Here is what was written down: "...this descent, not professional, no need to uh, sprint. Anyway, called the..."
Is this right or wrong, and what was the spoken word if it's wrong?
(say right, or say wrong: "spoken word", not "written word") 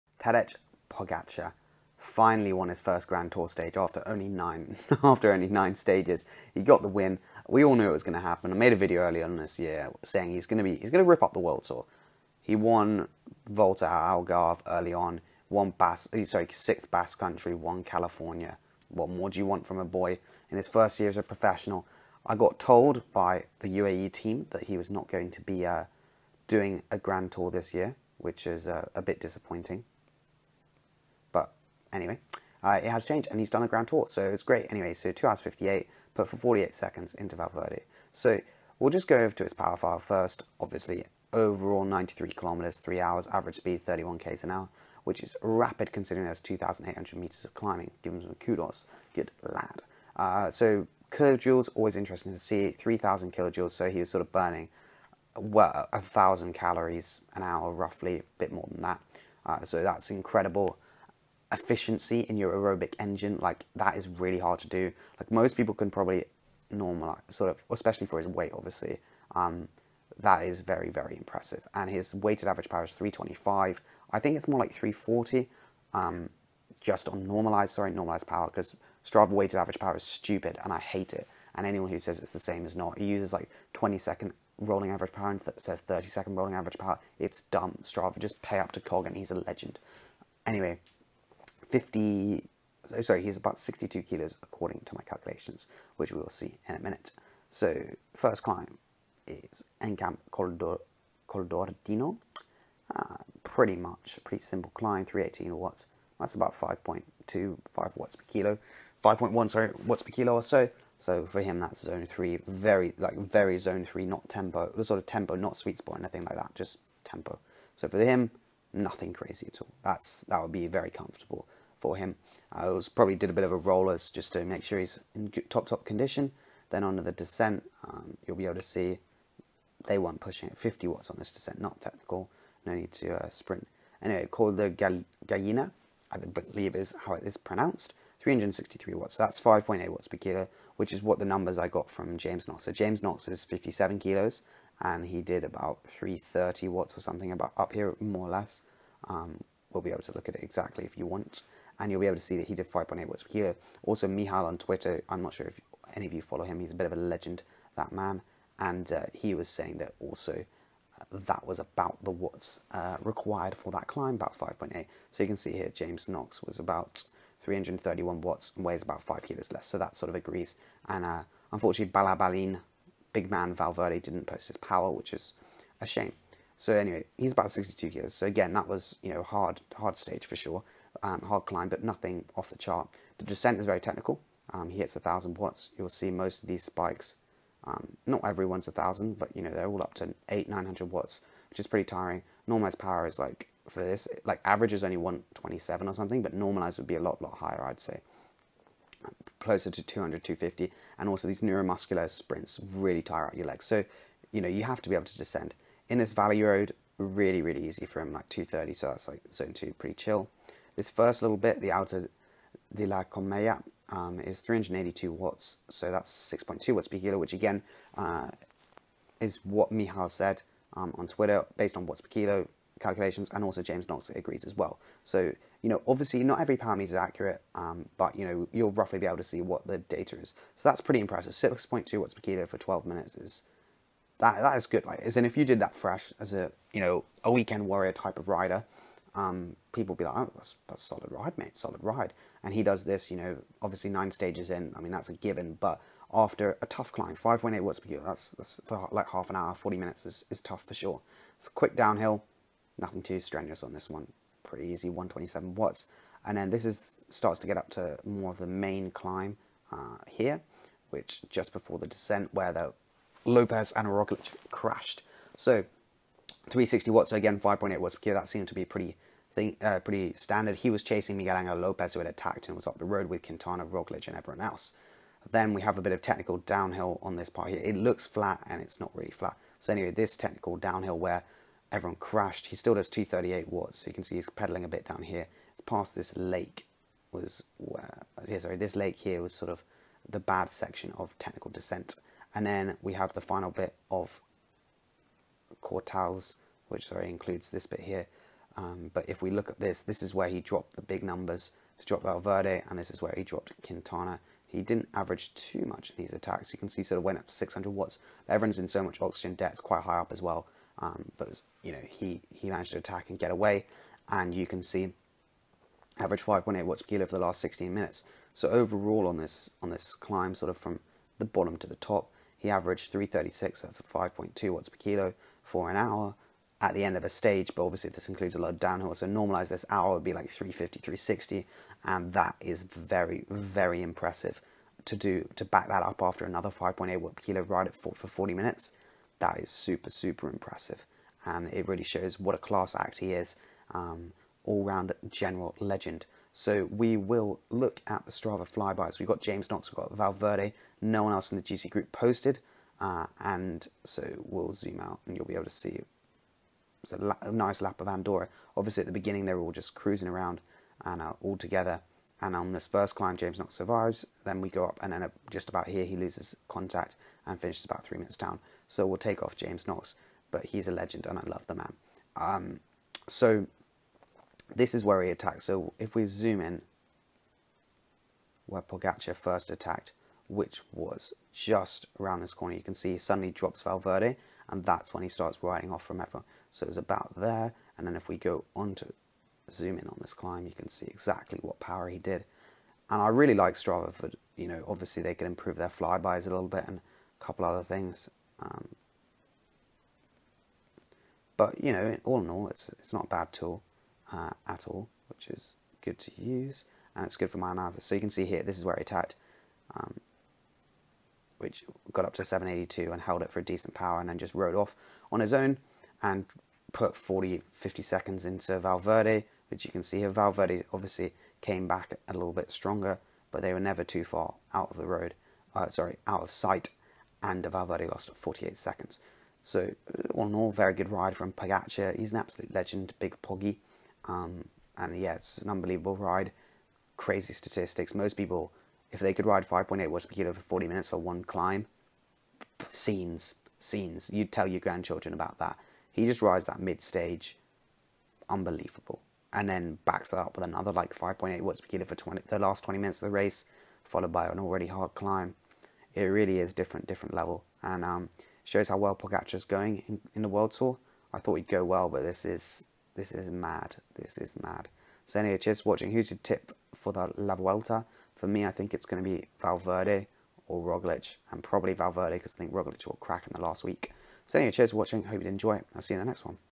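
wrong: "technical", not "professional".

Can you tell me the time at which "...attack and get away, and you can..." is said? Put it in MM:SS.
05:12.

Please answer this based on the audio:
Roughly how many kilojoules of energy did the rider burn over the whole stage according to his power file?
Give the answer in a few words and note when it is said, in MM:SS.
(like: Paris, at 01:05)
3,000 kilojoules, at 00:52.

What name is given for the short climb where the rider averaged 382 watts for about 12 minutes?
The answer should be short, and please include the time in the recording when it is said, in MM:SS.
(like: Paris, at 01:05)
Alto de la Comella, at 03:31.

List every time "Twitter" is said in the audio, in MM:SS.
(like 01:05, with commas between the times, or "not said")
02:34, 03:41.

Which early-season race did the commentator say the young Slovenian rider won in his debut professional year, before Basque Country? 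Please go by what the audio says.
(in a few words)
Volta Algarve.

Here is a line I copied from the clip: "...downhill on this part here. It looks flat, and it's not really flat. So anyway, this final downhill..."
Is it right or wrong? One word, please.
wrong.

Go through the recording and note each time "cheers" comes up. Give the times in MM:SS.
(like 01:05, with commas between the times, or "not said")
07:45, 07:54.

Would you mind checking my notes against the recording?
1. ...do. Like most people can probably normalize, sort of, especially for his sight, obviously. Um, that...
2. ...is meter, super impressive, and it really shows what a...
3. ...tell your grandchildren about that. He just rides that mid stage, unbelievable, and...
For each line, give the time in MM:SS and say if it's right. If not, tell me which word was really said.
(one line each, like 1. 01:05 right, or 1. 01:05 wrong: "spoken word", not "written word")
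1. 01:04 wrong: "weight", not "sight"
2. 05:39 wrong: "super", not "meter"
3. 07:24 right.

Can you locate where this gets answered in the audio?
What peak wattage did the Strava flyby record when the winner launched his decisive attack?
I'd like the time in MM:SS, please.
06:52.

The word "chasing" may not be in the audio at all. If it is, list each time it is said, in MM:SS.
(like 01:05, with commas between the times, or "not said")
04:30.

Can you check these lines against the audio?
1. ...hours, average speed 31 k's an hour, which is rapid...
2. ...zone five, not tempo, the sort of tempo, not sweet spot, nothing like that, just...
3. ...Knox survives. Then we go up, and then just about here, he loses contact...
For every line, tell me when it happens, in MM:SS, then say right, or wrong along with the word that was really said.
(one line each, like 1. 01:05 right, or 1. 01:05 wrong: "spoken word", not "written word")
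1. 00:42 right
2. 01:53 wrong: "three", not "five"
3. 06:03 right.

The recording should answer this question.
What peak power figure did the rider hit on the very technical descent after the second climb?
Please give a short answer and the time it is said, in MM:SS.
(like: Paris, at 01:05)
1,000 watts, at 03:04.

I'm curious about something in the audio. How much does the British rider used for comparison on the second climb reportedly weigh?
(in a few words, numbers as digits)
57 kilos.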